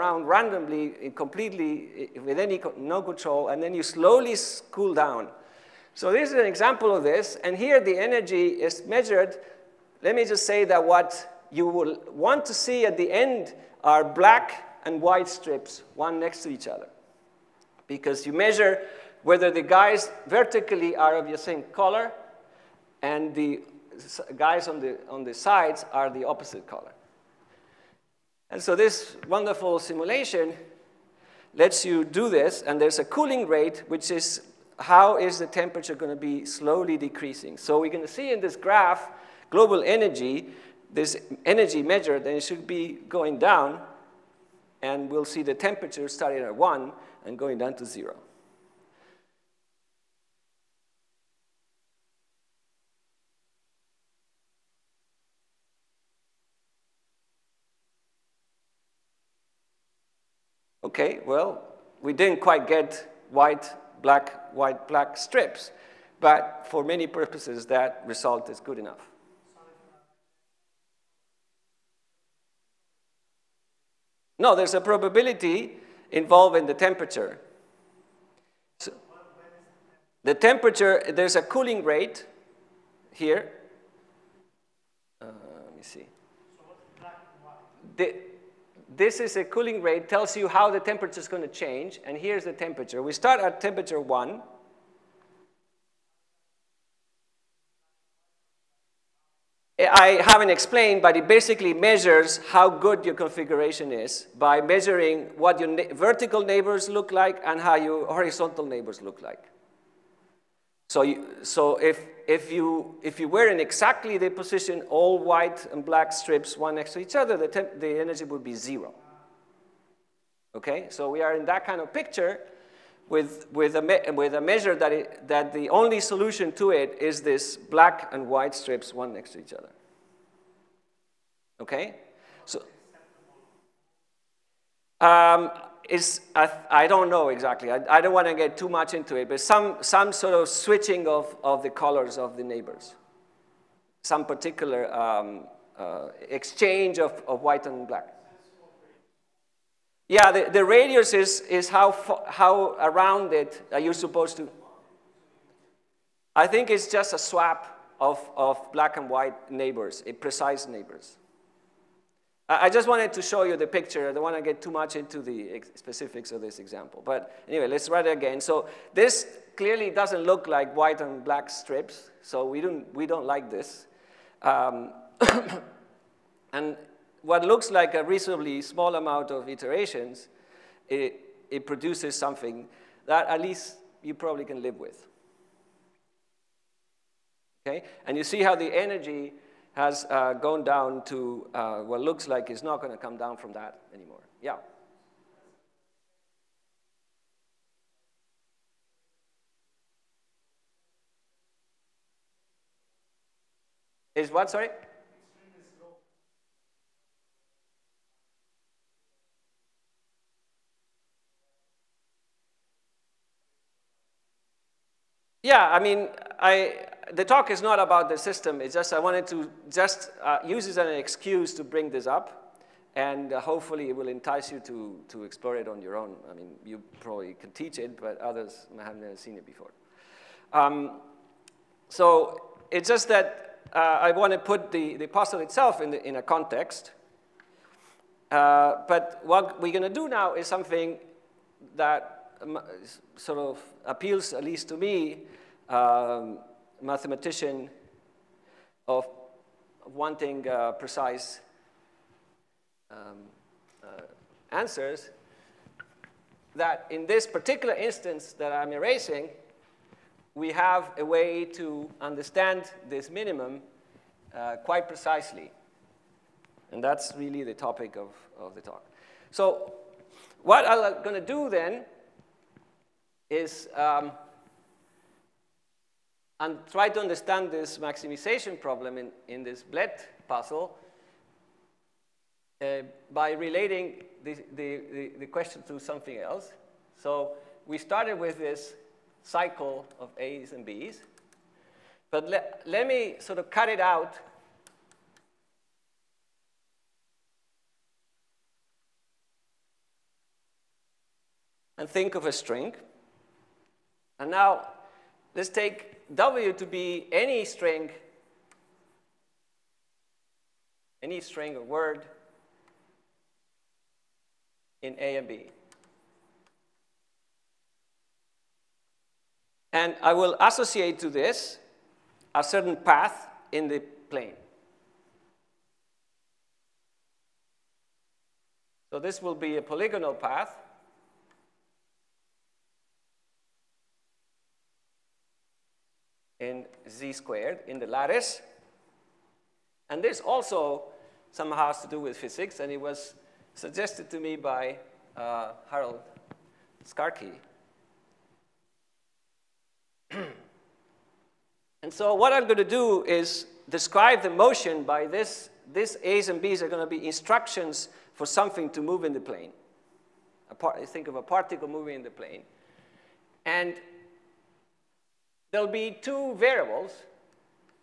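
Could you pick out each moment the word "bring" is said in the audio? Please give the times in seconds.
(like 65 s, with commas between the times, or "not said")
221 s.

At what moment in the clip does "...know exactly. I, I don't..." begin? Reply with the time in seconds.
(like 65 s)
137 s.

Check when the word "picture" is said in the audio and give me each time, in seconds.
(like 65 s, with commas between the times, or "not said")
121 s, 163 s.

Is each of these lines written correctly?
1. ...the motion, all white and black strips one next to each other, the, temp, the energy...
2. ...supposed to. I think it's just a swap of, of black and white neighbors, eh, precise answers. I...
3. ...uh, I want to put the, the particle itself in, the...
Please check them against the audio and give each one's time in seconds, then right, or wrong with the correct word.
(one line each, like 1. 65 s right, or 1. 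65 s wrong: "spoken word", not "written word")
1. 114 s wrong: "position", not "motion"
2. 153 s wrong: "neighbors", not "answers"
3. 233 s wrong: "puzzle", not "particle".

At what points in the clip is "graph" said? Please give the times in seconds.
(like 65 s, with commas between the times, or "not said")
38 s.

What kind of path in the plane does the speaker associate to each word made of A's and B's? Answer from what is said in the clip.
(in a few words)
polygonal path.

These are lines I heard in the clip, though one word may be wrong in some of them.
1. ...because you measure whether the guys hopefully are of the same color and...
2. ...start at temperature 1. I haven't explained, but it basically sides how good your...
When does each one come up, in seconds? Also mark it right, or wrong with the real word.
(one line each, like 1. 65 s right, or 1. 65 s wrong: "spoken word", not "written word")
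1. 17 s wrong: "vertically", not "hopefully"
2. 93 s wrong: "measures", not "sides".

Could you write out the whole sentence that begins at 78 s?
So the temperature, there's a cooling rate here.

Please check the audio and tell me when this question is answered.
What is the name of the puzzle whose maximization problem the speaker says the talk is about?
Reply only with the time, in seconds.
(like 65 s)
279 s.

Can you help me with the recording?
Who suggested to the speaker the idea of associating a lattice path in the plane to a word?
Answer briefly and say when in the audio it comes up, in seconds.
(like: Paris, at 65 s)
Harold Skarke, at 345 s.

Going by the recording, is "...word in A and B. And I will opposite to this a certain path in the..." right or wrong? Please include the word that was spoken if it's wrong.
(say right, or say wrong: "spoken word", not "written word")
wrong: "associate", not "opposite".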